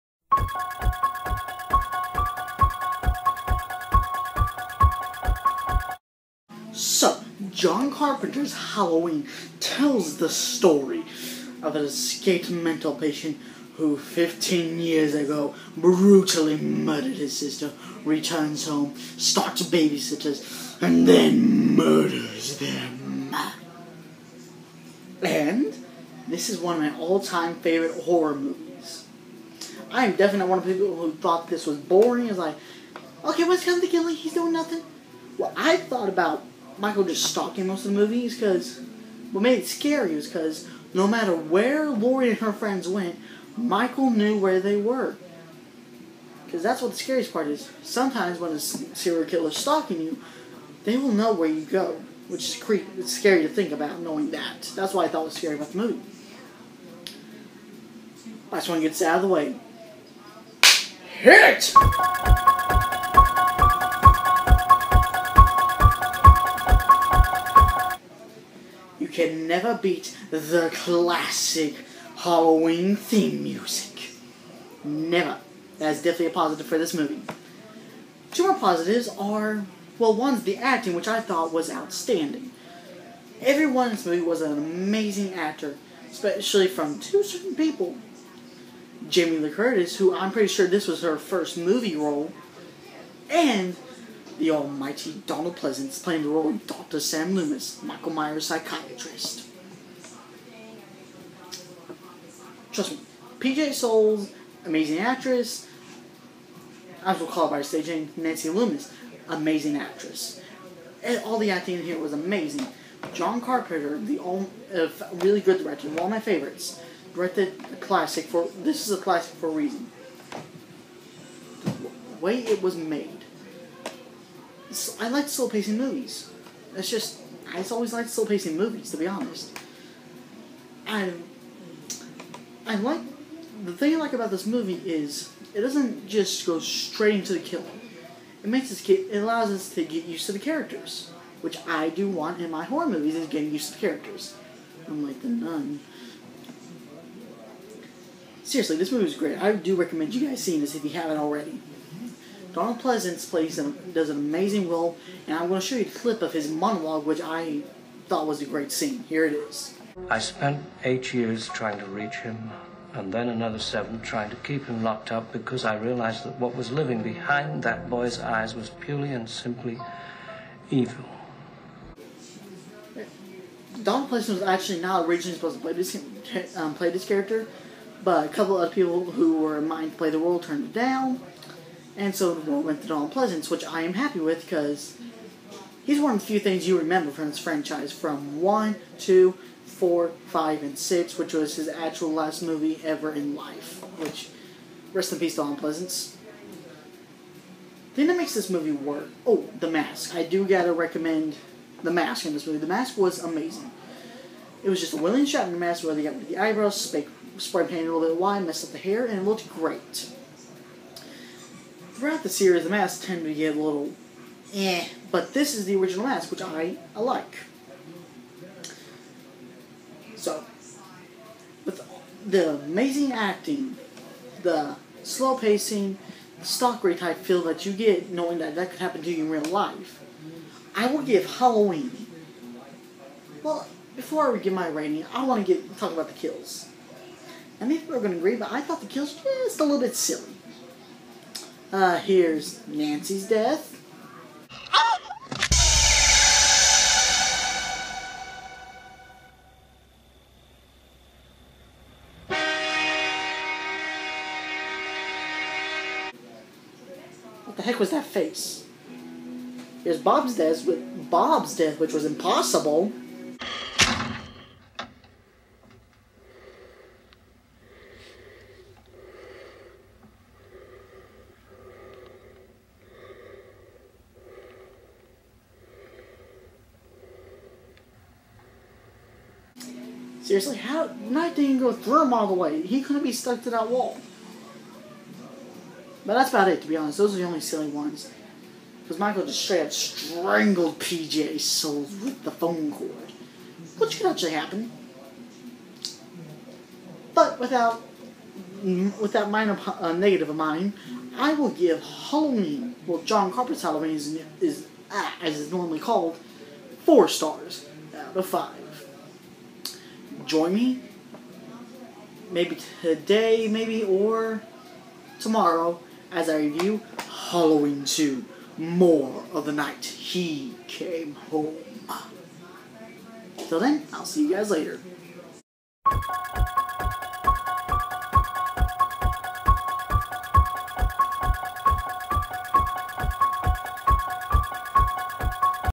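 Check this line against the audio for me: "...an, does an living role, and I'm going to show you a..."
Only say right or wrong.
wrong.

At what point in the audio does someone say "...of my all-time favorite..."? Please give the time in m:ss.
0:26.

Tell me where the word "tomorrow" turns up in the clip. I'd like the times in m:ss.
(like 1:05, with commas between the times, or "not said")
5:15.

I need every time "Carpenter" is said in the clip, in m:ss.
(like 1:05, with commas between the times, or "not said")
0:07, 1:53, 5:03.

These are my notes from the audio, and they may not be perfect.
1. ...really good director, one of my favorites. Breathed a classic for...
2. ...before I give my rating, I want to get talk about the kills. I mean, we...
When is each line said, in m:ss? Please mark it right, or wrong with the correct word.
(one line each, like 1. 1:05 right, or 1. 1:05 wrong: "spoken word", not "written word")
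1. 1:55 right
2. 3:53 right.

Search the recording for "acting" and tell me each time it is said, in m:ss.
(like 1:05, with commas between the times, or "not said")
1:20, 1:51, 3:43.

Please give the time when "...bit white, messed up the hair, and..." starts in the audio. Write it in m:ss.
3:28.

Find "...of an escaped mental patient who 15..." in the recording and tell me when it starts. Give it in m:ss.
0:11.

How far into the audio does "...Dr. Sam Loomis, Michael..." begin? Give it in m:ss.
1:36.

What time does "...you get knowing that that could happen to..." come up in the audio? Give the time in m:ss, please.
3:47.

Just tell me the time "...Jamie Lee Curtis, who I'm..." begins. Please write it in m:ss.
1:29.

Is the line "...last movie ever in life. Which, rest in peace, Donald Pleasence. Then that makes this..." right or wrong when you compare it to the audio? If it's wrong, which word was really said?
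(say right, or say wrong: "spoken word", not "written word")
right.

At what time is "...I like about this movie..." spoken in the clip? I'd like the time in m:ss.
2:13.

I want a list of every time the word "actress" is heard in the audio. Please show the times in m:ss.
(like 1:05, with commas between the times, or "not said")
1:44, 1:49.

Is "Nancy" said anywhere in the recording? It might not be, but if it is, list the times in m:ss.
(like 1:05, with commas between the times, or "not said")
1:48, 4:02.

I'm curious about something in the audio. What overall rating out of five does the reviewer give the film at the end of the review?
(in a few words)
4.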